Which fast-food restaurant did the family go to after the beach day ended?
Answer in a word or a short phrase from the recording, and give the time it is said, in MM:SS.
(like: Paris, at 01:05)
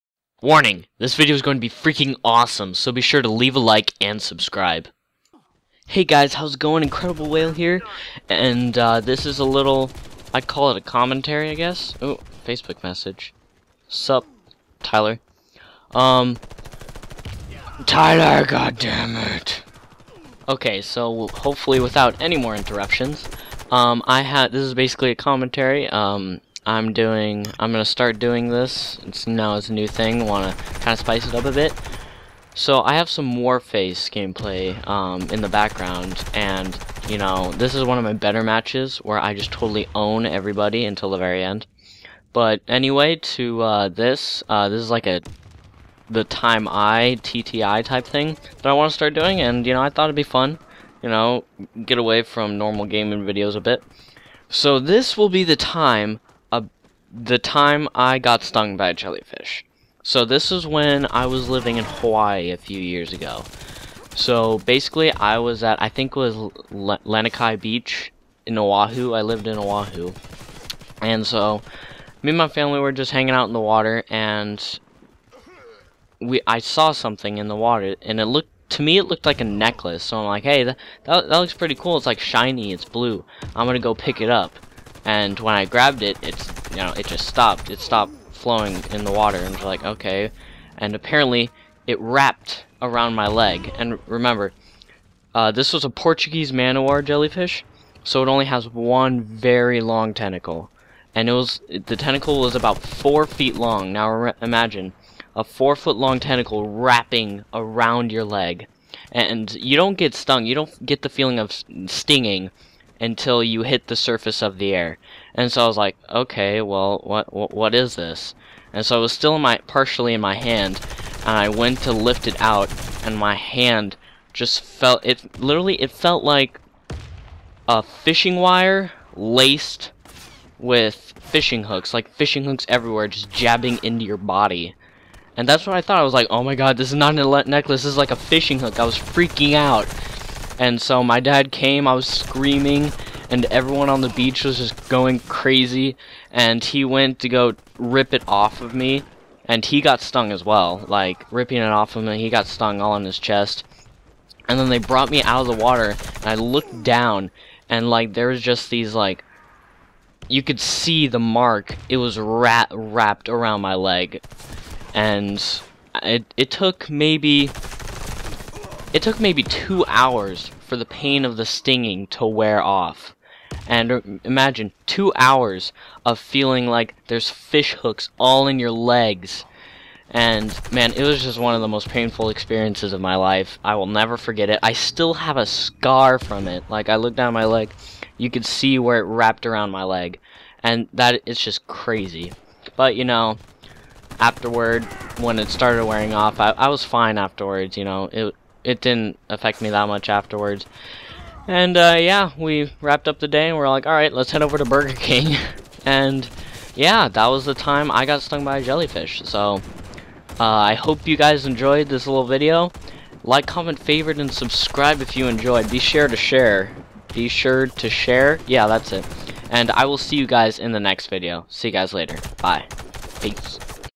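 Burger King, at 03:24.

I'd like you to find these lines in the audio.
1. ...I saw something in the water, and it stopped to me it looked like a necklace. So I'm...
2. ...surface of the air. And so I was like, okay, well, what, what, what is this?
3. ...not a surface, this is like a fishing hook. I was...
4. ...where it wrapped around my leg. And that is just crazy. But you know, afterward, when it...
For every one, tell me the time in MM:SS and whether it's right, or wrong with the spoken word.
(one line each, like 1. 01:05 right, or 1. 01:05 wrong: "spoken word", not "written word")
1. 01:16 wrong: "looked", not "stopped"
2. 01:53 right
3. 02:16 wrong: "necklace", not "surface"
4. 03:08 right.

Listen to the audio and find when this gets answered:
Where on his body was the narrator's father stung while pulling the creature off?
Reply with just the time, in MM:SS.
02:33.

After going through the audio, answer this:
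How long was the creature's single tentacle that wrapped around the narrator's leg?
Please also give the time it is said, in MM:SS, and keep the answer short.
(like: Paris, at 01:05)
4 feet, at 01:42.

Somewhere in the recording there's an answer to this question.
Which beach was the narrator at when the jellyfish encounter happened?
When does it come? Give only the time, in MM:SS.
01:06.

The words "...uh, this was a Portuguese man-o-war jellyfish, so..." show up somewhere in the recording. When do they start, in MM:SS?
01:35.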